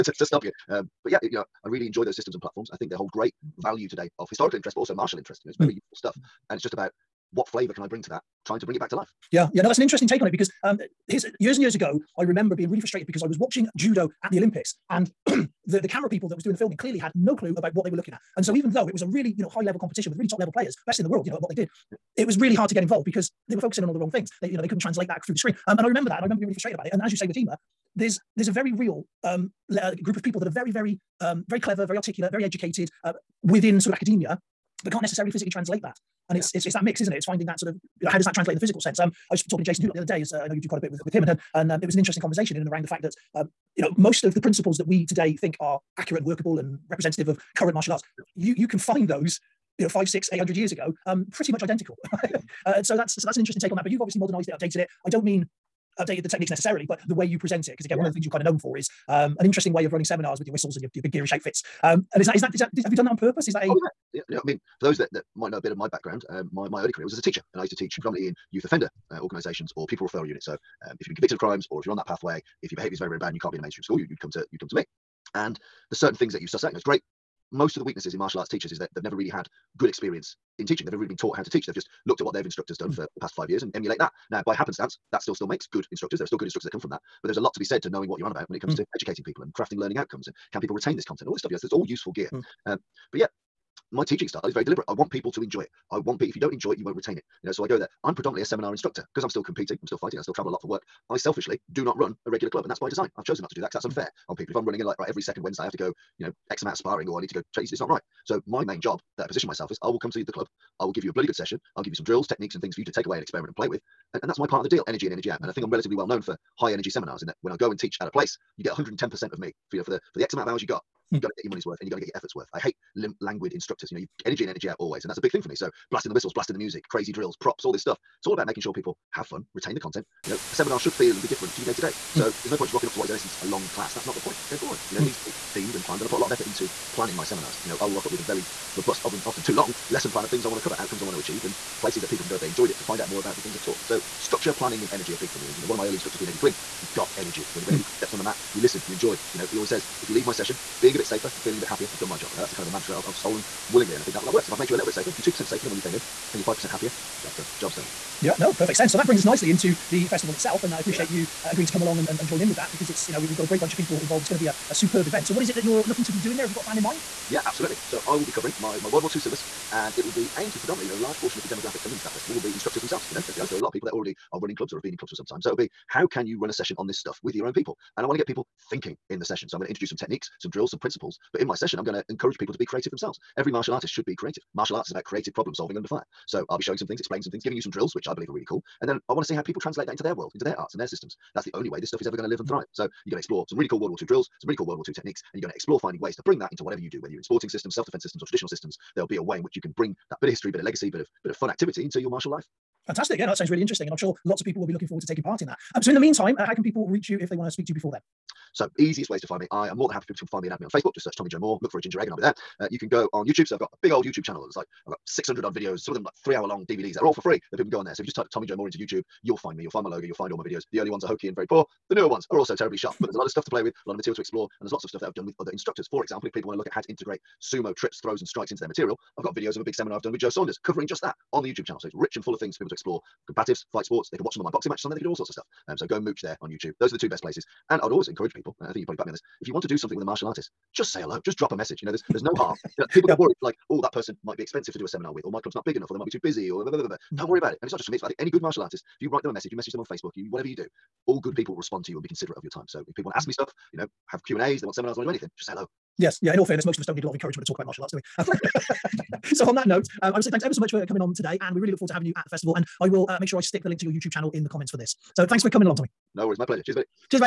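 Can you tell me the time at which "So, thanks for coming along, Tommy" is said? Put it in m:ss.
4:25.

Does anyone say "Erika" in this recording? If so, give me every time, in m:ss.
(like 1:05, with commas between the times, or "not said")
not said.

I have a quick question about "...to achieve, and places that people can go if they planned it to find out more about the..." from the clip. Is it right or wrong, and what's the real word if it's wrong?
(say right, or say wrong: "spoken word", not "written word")
wrong: "enjoyed", not "planned".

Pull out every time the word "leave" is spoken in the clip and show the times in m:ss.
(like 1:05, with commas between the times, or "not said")
2:30.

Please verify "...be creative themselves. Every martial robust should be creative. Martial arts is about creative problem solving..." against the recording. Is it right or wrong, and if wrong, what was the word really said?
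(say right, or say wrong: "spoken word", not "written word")
wrong: "artist", not "robust".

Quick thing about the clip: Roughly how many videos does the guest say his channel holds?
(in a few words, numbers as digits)
600.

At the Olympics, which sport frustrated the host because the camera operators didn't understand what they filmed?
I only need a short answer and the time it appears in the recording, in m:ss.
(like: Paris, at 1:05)
Judo, at 0:13.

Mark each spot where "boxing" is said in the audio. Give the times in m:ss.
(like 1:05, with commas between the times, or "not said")
3:54.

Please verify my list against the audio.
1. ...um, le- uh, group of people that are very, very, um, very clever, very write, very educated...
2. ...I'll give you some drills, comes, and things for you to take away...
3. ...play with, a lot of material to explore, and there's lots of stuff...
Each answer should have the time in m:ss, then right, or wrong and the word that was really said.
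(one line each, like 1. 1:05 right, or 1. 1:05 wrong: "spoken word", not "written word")
1. 0:29 wrong: "articulate", not "write"
2. 1:51 wrong: "techniques", not "comes"
3. 3:43 right.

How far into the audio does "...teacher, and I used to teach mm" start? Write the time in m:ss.
1:07.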